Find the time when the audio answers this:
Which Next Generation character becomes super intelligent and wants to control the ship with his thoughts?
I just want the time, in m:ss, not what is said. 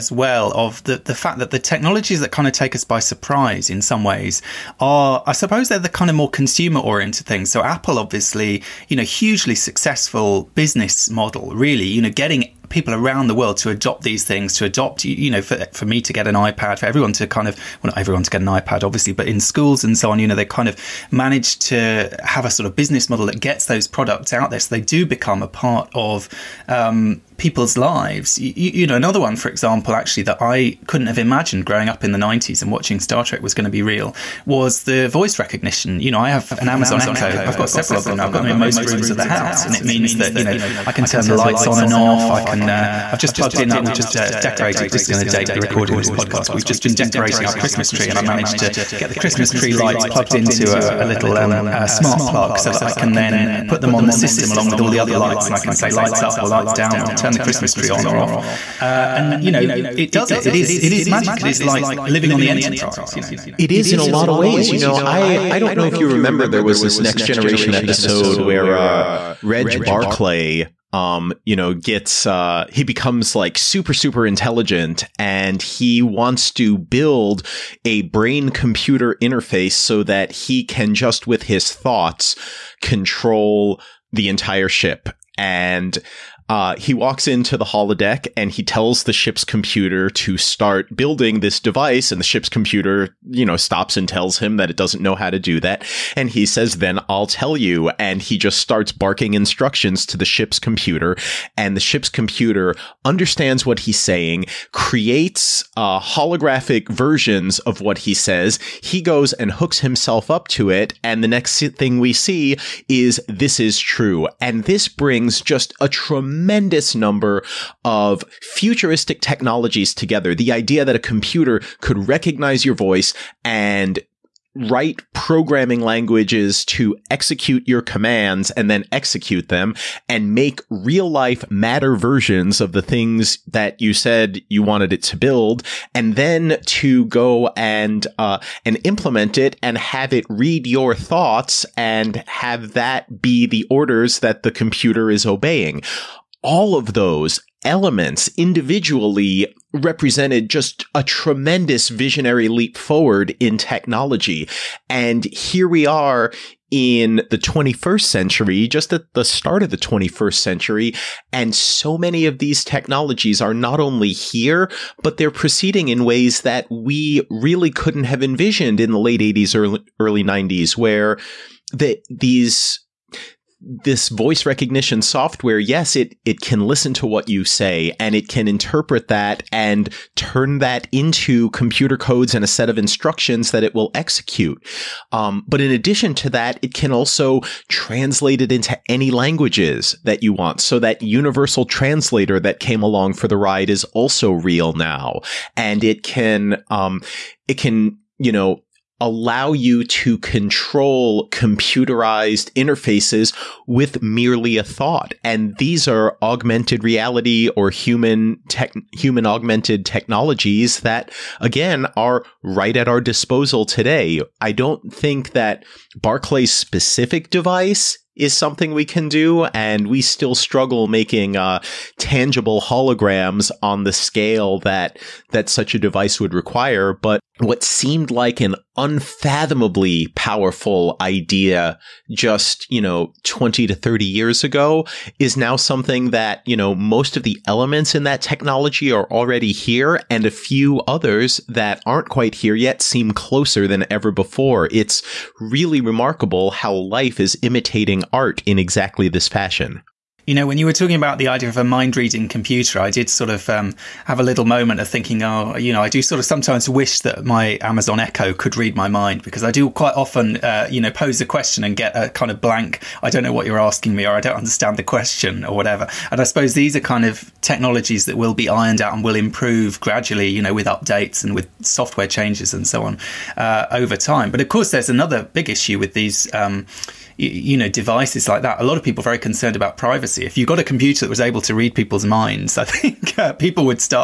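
1:09.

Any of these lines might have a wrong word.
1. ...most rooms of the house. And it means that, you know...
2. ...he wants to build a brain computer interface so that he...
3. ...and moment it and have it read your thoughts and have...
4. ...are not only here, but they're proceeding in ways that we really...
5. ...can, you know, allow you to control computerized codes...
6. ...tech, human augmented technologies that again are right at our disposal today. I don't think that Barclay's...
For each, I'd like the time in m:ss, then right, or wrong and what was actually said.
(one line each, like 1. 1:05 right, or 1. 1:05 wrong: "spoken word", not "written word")
1. 0:38 right
2. 1:15 right
3. 2:18 wrong: "implement", not "moment"
4. 2:43 right
5. 3:17 wrong: "interfaces", not "codes"
6. 3:28 right.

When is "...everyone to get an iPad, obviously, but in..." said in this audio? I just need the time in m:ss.
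0:17.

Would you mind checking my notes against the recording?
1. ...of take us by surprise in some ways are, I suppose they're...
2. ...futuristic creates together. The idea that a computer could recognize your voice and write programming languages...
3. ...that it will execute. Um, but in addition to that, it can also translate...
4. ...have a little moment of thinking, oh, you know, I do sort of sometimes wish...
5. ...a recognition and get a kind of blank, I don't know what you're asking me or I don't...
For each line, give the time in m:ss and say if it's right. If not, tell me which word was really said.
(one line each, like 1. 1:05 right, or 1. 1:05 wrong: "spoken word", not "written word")
1. 0:02 right
2. 1:58 wrong: "technologies", not "creates"
3. 3:03 right
4. 4:14 right
5. 4:21 wrong: "question", not "recognition".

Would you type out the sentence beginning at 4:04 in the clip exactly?
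It's really remarkable how life is imitating art in exactly this fashion.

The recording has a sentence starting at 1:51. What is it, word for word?
And the next thing we see is this is true.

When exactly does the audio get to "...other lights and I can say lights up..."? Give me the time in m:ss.
0:54.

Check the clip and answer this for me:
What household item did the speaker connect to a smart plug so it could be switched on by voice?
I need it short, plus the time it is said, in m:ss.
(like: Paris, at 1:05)
Christmas tree lights, at 0:49.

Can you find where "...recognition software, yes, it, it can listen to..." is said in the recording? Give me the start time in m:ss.
2:54.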